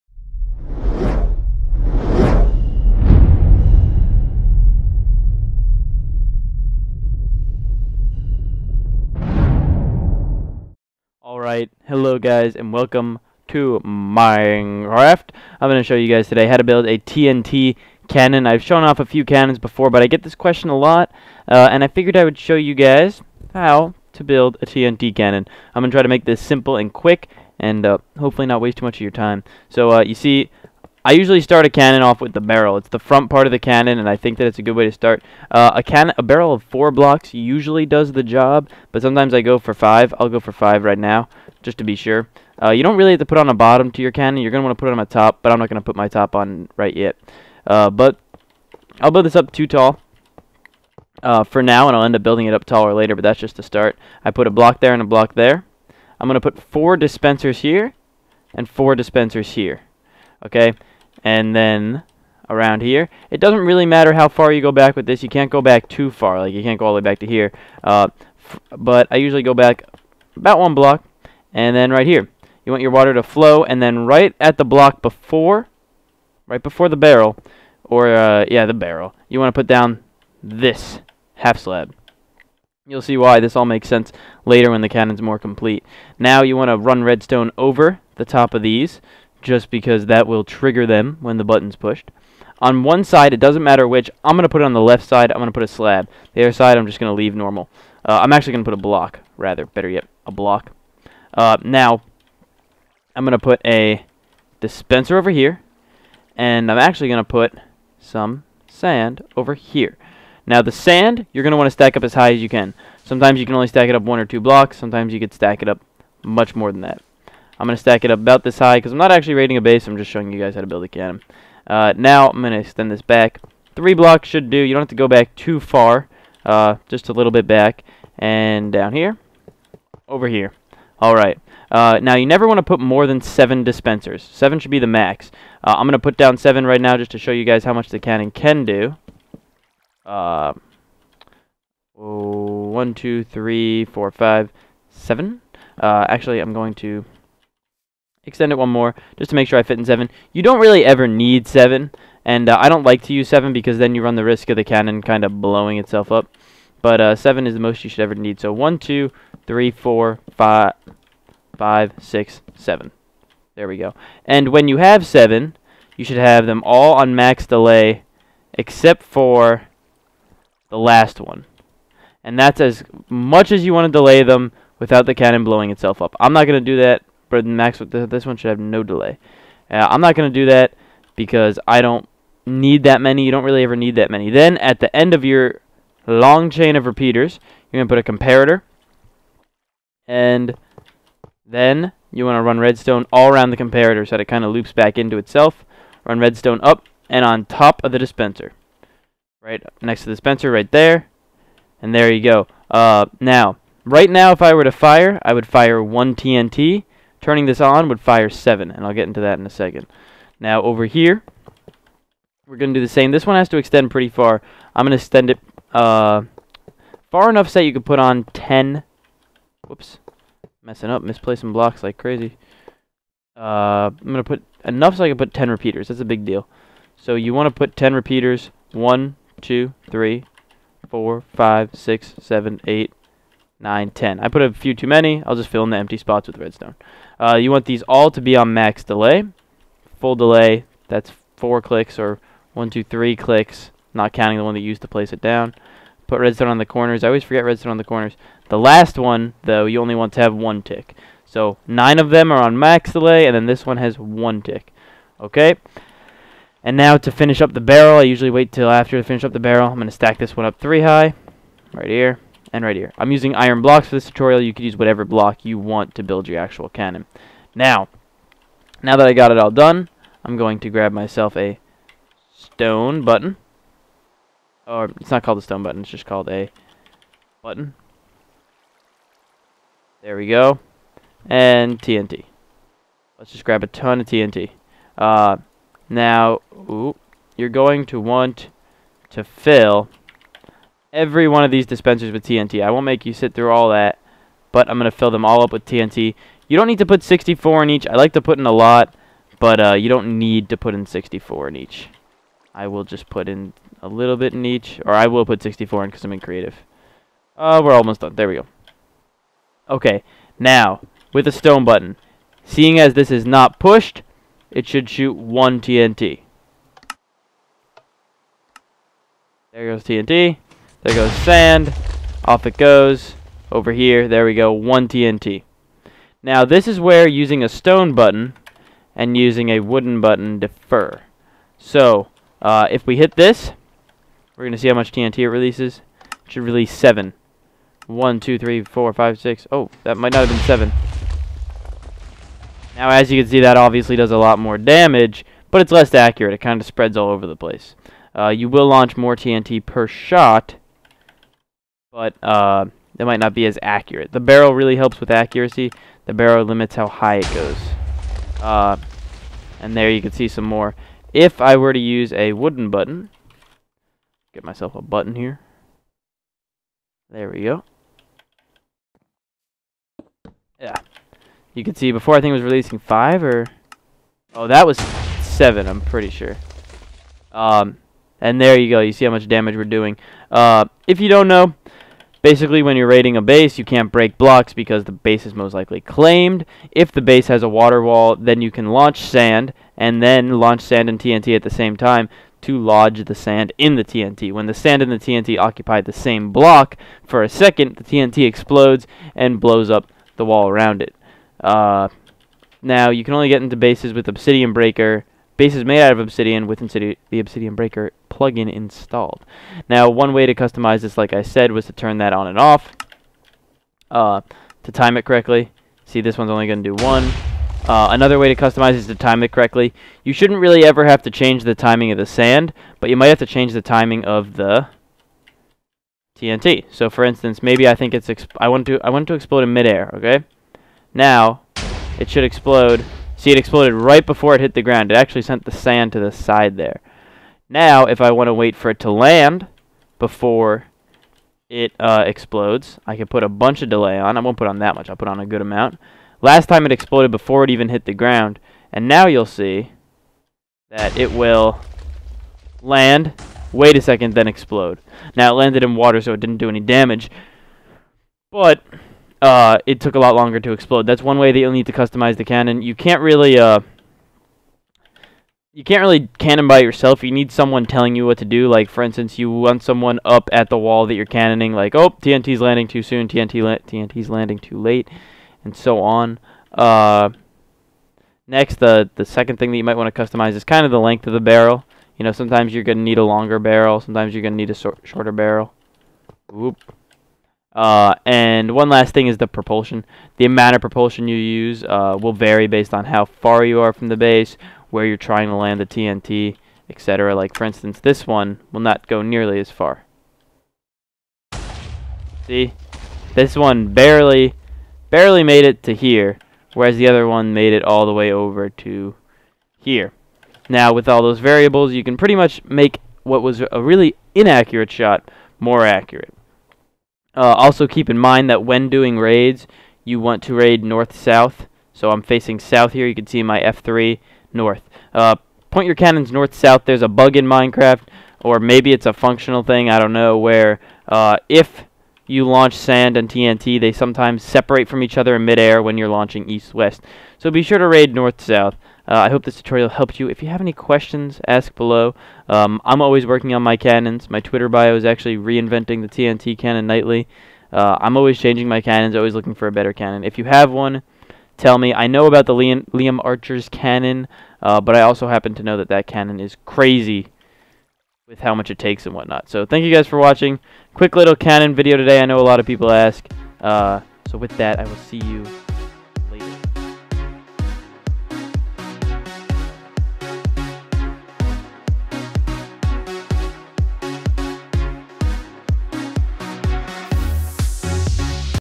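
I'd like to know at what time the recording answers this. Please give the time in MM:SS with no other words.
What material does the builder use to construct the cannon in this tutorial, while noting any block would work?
04:23.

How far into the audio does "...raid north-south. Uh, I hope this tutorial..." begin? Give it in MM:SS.
08:57.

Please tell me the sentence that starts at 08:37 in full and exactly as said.
Uh, also, keep in mind that when doing raids, you want to raid north-south.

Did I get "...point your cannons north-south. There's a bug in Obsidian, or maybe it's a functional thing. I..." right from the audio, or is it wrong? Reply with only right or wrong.
wrong.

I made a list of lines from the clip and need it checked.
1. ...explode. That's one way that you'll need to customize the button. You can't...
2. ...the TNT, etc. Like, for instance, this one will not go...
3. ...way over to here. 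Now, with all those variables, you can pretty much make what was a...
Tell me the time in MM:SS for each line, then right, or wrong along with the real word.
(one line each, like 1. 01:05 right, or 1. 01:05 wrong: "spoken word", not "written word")
1. 07:40 wrong: "cannon", not "button"
2. 08:15 right
3. 08:27 right.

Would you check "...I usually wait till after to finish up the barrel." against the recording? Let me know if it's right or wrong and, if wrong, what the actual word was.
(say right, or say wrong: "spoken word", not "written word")
right.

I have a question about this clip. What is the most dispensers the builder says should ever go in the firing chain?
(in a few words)
7.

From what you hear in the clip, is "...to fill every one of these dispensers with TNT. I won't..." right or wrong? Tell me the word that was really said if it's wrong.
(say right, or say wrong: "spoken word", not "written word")
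right.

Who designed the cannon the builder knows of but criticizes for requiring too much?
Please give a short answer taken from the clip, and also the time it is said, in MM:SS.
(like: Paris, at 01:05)
Liam Archer, at 09:12.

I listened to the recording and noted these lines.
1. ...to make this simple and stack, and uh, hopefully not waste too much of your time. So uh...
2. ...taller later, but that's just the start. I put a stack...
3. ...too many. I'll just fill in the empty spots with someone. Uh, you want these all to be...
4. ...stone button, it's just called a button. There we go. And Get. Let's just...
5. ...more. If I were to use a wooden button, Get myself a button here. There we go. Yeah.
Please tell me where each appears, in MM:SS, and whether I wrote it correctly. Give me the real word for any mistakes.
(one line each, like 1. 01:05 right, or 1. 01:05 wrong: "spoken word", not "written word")
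1. 00:26 wrong: "quick", not "stack"
2. 00:52 wrong: "block", not "stack"
3. 03:54 wrong: "redstone", not "someone"
4. 04:35 wrong: "TNT", not "Get"
5. 06:00 right.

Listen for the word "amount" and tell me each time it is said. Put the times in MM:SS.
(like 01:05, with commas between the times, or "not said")
07:25, 08:10.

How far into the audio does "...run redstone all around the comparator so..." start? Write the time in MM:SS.
03:12.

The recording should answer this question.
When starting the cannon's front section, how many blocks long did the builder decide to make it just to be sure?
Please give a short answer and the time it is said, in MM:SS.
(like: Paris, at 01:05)
5, at 00:40.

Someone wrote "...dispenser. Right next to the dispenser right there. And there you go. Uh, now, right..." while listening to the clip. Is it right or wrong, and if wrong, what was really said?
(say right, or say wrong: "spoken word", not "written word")
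right.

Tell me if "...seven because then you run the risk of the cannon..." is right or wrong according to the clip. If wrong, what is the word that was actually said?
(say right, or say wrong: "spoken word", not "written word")
right.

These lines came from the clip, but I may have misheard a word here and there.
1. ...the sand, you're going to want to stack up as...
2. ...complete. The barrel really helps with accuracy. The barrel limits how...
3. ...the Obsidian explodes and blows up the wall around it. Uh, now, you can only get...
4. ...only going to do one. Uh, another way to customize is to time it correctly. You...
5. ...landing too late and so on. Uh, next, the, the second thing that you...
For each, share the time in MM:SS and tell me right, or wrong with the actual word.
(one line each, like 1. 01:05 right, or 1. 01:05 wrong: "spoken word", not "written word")
1. 01:50 right
2. 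05:53 wrong: "accurate", not "complete"
3. 06:37 wrong: "TNT", not "Obsidian"
4. 06:56 right
5. 07:54 right.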